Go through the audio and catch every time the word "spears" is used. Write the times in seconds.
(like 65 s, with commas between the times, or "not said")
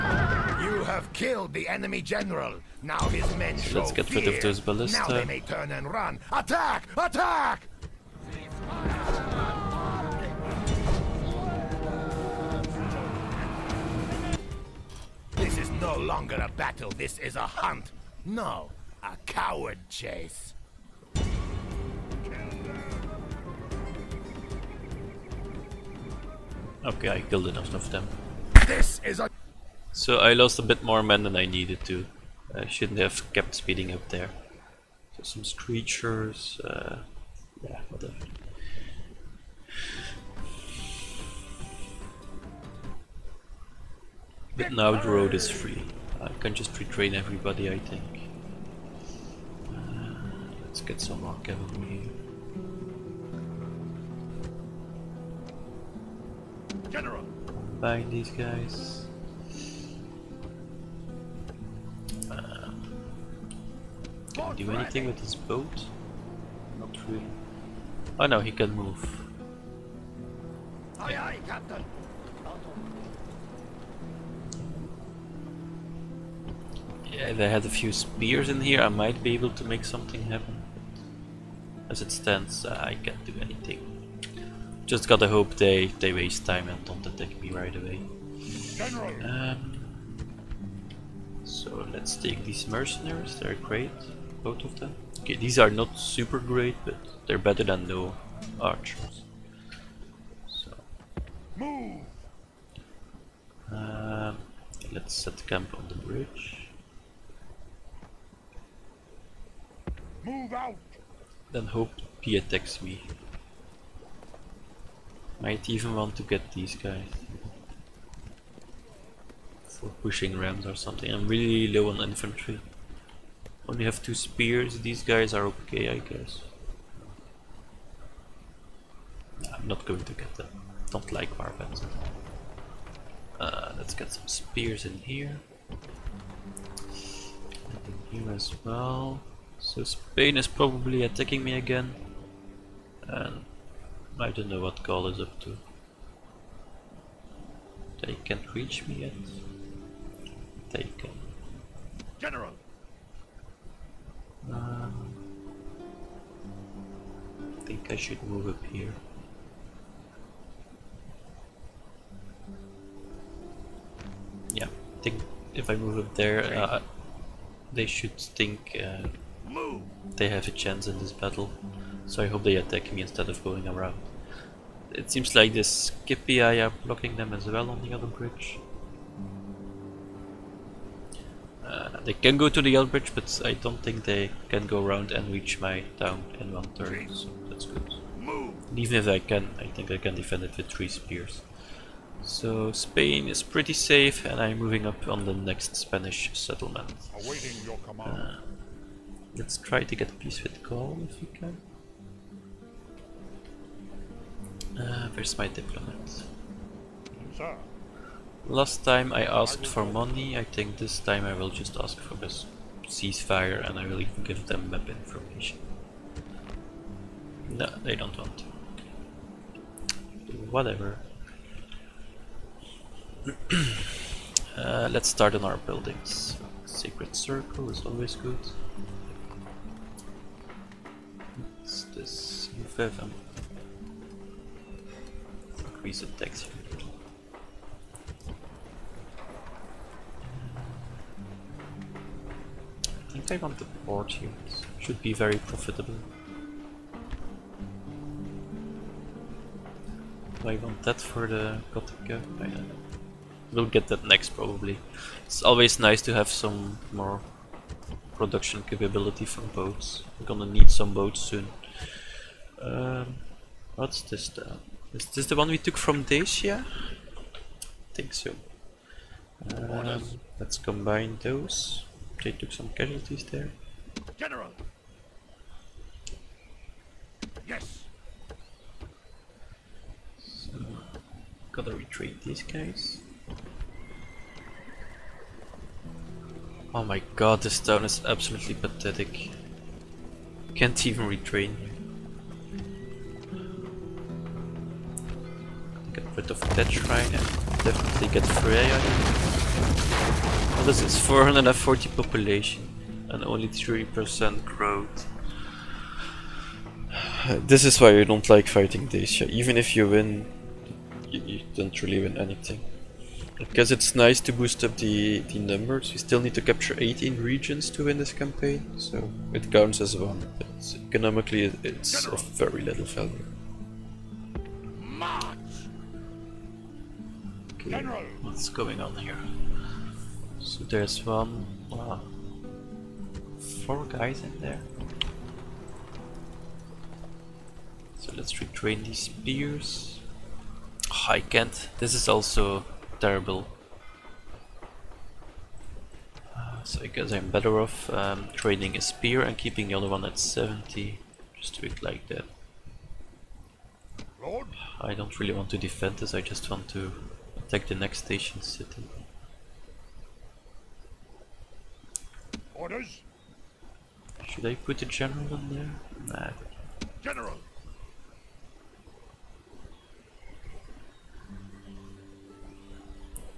77 s, 124 s, 134 s, 190 s, 339 s, 348 s.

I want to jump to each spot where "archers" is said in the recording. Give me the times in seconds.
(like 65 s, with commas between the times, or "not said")
98 s.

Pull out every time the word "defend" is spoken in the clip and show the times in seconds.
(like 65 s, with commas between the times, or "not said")
190 s, 355 s.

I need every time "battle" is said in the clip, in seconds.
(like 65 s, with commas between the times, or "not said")
16 s, 171 s.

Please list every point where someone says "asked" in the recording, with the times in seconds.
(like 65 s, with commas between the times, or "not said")
209 s.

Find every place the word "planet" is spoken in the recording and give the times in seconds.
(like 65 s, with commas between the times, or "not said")
not said.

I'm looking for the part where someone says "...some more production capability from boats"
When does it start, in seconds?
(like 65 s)
256 s.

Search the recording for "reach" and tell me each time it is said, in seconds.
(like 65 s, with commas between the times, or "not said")
148 s, 185 s.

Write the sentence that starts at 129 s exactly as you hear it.
I'm not going to get them.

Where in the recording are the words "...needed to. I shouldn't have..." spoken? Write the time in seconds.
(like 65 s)
31 s.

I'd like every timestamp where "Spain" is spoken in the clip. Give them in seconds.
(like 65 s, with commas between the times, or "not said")
139 s, 192 s.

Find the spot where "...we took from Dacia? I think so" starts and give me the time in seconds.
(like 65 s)
265 s.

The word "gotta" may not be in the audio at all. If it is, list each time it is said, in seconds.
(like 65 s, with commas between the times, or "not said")
85 s, 281 s.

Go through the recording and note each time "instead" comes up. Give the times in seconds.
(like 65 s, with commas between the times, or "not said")
173 s.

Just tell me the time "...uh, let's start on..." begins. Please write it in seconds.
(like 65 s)
224 s.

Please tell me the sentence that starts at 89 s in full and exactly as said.
Um, so let's take these mercenaries.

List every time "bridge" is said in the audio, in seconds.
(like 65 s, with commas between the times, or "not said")
105 s, 178 s, 182 s.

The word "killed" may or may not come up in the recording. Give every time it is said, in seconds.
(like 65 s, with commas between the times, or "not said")
1 s, 27 s.